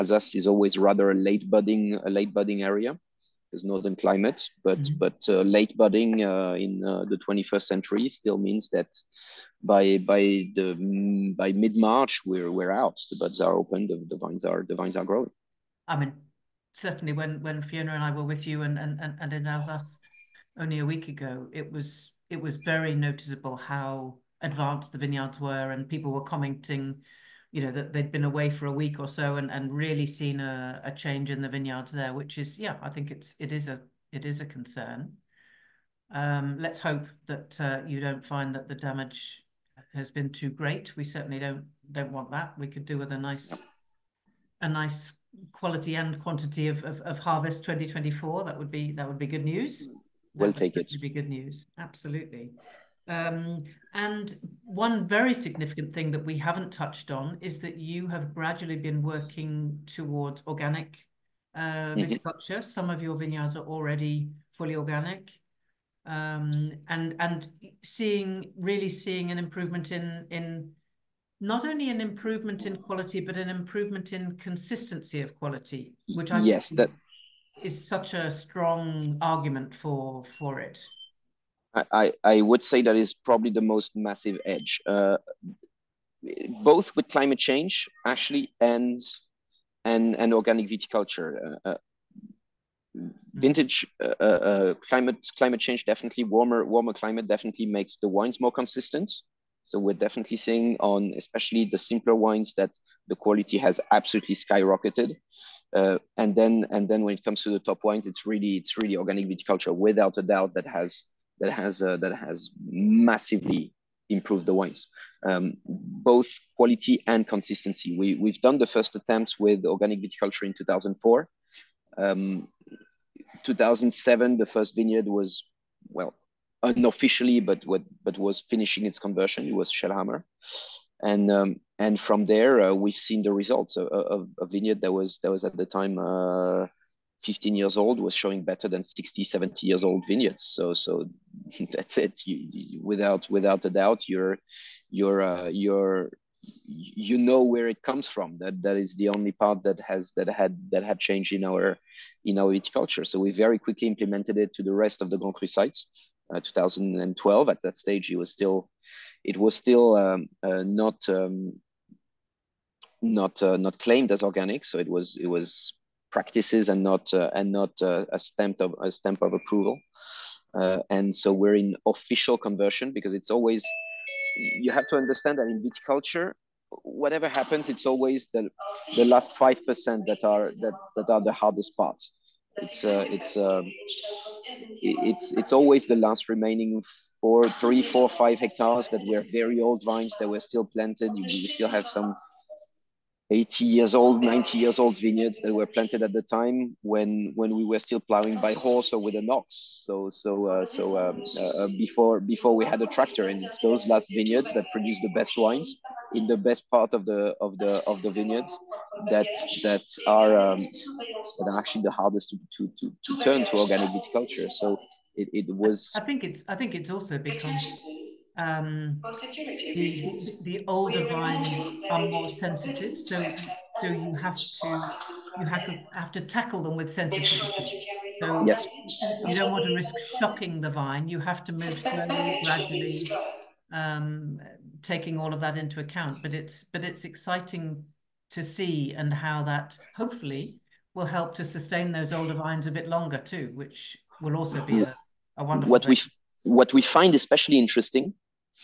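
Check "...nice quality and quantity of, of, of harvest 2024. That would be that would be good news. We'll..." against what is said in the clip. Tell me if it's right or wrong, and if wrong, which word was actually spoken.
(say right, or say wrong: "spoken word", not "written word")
right.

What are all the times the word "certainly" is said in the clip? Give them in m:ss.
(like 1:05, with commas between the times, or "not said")
0:16, 0:41.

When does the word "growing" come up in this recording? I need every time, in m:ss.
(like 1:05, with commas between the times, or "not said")
0:15.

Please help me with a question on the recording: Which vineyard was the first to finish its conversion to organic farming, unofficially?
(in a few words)
Schoelhammer.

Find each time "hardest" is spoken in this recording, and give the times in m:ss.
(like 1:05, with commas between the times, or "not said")
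3:01, 3:31.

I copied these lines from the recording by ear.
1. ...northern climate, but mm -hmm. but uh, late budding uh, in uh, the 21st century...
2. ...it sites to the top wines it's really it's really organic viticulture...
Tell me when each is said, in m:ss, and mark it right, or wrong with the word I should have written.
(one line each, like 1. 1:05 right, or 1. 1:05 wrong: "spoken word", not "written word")
1. 0:03 right
2. 1:47 wrong: "comes", not "sites".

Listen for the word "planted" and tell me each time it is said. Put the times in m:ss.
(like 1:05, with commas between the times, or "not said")
3:10, 3:15.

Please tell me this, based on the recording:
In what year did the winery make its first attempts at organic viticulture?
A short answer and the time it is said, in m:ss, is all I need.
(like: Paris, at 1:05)
2004, at 2:00.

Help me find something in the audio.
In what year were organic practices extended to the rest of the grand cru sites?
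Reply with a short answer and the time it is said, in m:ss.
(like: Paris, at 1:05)
2012, at 2:36.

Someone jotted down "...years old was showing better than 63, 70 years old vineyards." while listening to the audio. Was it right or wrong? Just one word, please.
wrong.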